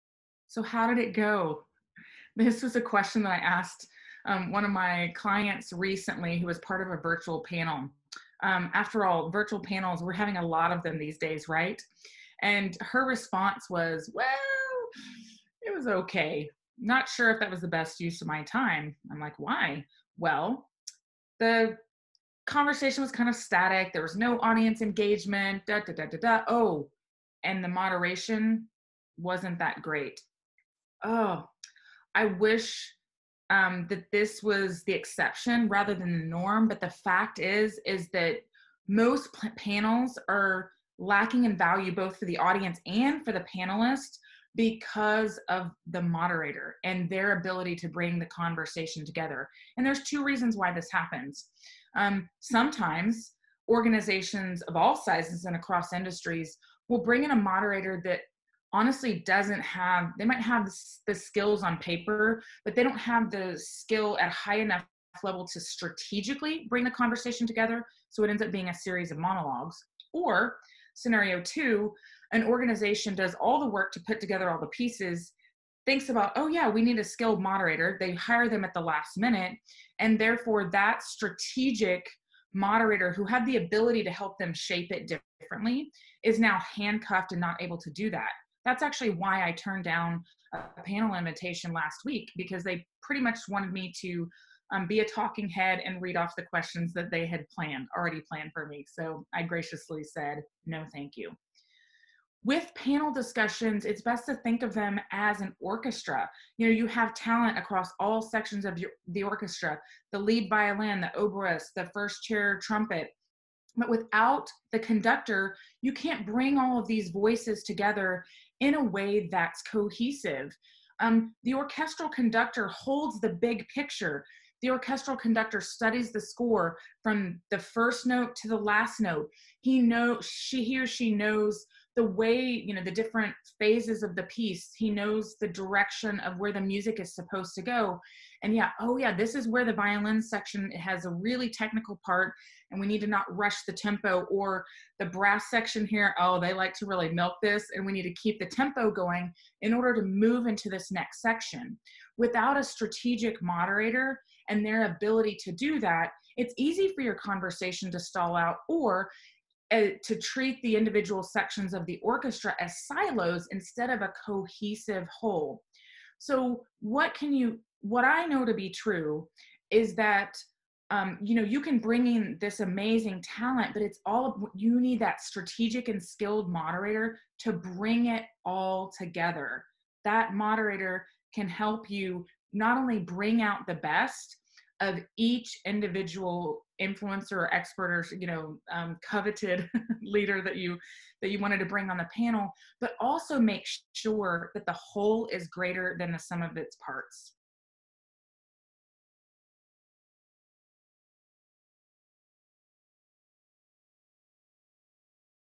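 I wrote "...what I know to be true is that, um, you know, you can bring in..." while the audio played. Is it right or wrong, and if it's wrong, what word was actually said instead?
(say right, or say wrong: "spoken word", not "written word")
right.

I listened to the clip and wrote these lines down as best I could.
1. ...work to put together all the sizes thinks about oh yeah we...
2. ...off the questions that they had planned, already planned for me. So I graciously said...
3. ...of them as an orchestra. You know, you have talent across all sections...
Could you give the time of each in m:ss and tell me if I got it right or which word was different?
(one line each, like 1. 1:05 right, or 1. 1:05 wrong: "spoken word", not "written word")
1. 1:13 wrong: "pieces", not "sizes"
2. 1:36 right
3. 1:44 right.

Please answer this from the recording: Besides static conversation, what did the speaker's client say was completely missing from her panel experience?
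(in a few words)
audience engagement.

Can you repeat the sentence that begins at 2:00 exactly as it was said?
Um, the orchestral conductor holds the big picture.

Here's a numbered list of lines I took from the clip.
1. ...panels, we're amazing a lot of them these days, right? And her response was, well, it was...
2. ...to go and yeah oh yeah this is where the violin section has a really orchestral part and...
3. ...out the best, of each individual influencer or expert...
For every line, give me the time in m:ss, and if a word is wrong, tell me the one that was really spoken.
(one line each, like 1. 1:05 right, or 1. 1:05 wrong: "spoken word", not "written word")
1. 0:09 wrong: "having", not "amazing"
2. 2:17 wrong: "technical", not "orchestral"
3. 3:03 right.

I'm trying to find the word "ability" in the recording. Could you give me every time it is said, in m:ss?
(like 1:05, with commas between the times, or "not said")
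0:47, 1:23, 2:34.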